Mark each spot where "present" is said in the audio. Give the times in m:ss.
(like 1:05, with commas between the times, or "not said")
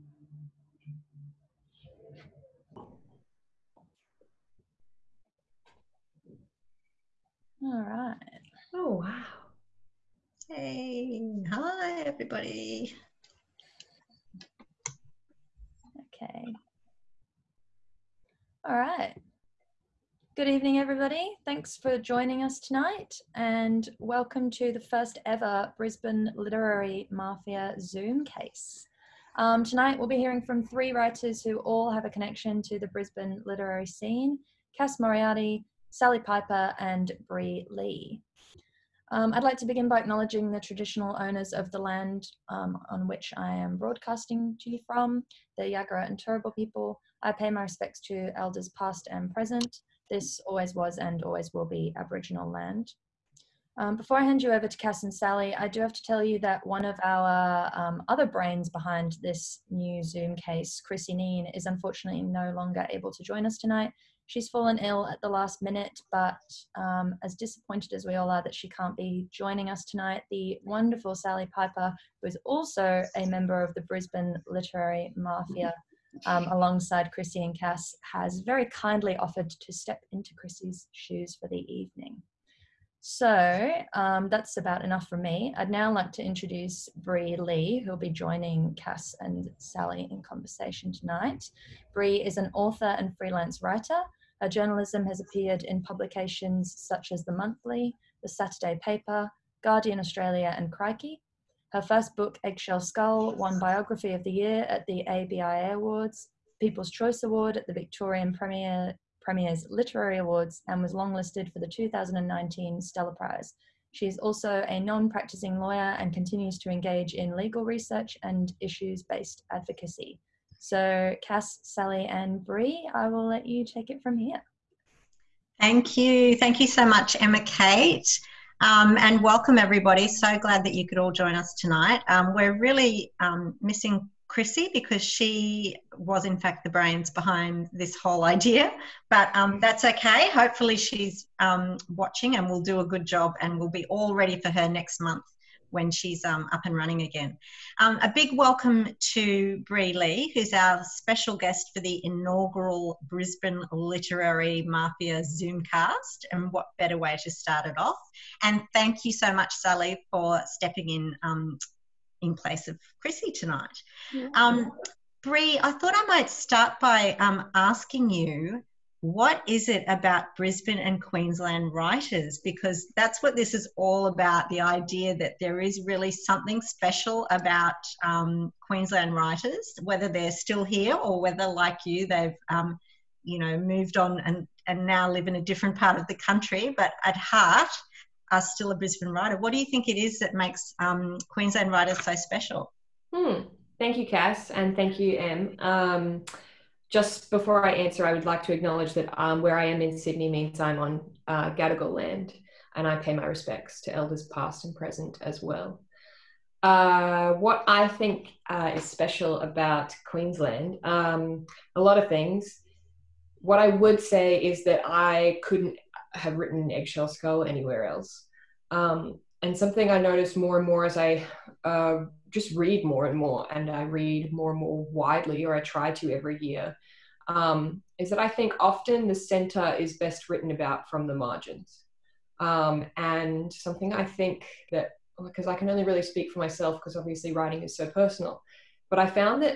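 0:49, 3:24.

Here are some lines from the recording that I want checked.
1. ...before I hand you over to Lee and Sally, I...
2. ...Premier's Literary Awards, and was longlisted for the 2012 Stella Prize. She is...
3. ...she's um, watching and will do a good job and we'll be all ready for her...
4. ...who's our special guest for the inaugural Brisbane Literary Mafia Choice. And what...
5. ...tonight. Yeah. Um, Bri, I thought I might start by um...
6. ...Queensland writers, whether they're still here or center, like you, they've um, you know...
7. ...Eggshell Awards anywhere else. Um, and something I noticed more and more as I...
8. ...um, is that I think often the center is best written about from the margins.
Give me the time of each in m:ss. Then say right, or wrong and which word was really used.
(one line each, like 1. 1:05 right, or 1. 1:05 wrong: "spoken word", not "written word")
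1. 0:53 wrong: "Cass", not "Lee"
2. 1:49 wrong: "2019", not "2012"
3. 2:20 right
4. 2:30 wrong: "Zoomcast", not "Choice"
5. 2:43 right
6. 2:58 wrong: "whether", not "center"
7. 3:36 wrong: "Skull", not "Awards"
8. 3:47 right.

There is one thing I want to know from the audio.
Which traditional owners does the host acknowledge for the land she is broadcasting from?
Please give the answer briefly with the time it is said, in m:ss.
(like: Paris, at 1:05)
Yagara and Turrbal, at 0:45.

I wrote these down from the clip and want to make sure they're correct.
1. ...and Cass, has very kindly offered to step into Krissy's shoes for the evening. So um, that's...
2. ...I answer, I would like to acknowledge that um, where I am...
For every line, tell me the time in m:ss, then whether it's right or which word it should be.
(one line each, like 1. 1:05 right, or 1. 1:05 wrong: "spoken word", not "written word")
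1. 1:17 right
2. 3:17 right.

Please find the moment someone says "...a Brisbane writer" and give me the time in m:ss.
3:08.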